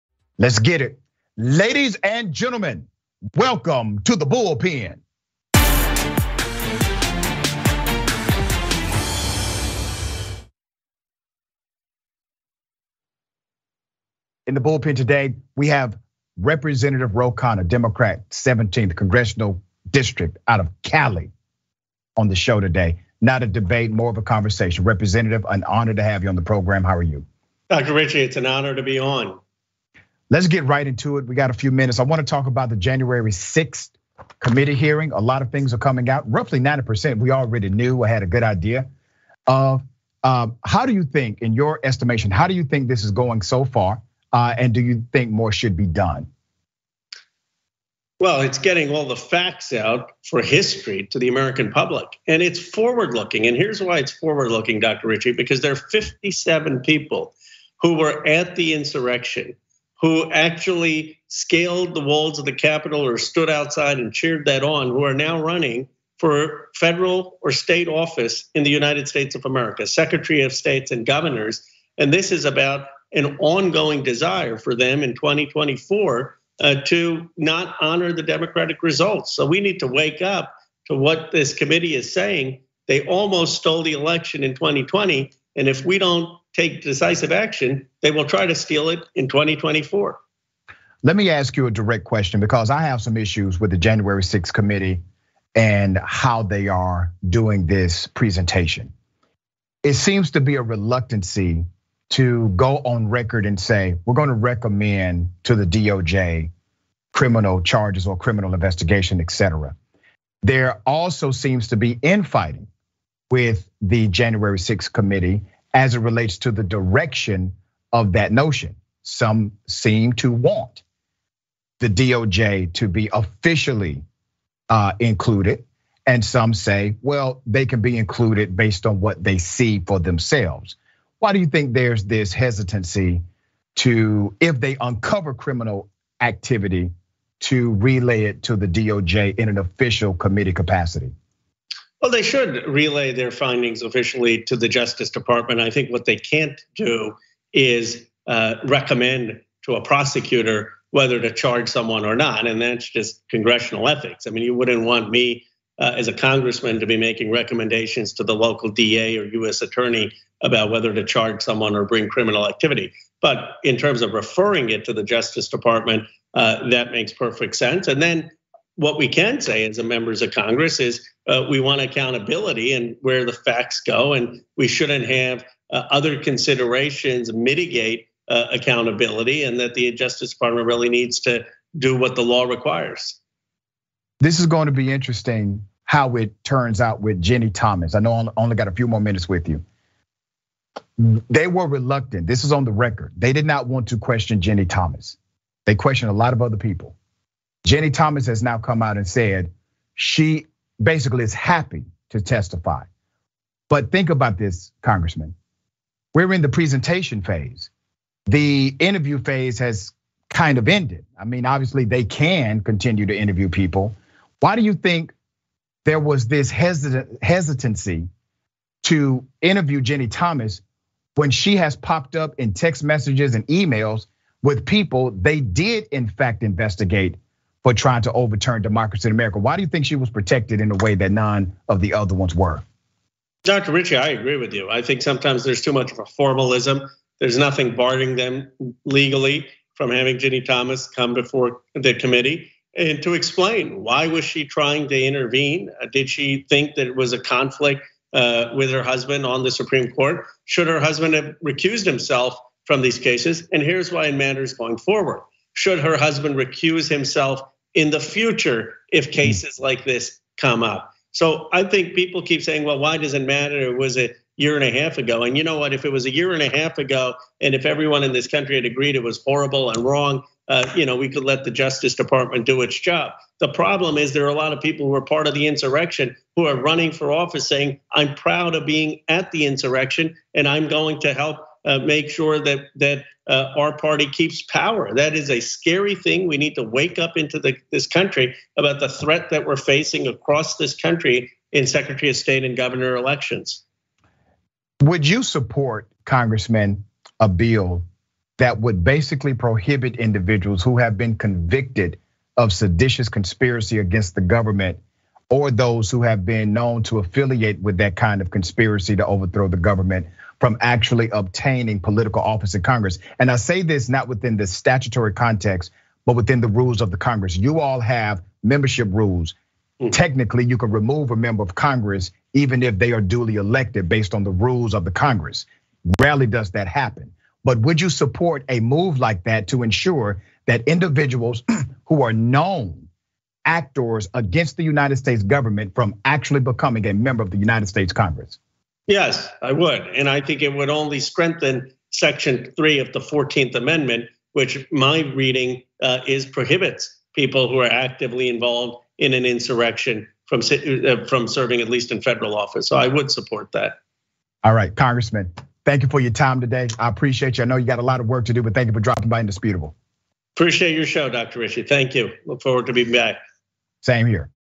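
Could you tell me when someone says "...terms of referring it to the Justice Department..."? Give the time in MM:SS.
02:43.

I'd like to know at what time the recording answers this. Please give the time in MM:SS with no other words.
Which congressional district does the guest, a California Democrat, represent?
00:18.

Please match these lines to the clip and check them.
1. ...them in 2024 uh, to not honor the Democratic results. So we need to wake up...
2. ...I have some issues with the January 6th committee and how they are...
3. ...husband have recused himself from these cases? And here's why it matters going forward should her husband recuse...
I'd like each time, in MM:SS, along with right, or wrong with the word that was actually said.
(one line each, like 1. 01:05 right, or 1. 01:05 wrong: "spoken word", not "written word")
1. 01:14 right
2. 01:32 right
3. 04:10 right.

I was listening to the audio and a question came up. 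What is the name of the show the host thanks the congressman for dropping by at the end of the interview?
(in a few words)
Indisputable.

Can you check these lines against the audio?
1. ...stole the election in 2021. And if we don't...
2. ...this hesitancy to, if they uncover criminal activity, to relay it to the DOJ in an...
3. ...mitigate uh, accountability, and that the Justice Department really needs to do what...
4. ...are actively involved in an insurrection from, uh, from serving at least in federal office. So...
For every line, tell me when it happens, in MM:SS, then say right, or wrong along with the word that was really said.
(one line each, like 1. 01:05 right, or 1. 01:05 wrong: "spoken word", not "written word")
1. 01:23 wrong: "2020", not "2021"
2. 02:12 right
3. 02:57 right
4. 05:47 right.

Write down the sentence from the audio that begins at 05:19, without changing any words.
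Technically, you can remove a member of Congress even if they are duly elected based on the rules of the Congress.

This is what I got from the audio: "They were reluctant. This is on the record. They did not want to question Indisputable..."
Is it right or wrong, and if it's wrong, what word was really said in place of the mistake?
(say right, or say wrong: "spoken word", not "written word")
wrong: "Ginni", not "Indisputable".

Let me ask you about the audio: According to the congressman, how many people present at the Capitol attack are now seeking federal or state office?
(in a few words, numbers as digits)
57.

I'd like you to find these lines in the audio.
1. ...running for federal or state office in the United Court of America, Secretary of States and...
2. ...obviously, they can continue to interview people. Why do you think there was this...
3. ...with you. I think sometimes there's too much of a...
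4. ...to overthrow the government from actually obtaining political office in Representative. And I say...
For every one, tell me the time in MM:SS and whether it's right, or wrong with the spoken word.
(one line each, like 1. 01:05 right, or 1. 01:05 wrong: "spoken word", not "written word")
1. 01:05 wrong: "States", not "Court"
2. 03:31 right
3. 03:54 right
4. 05:08 wrong: "Congress", not "Representative".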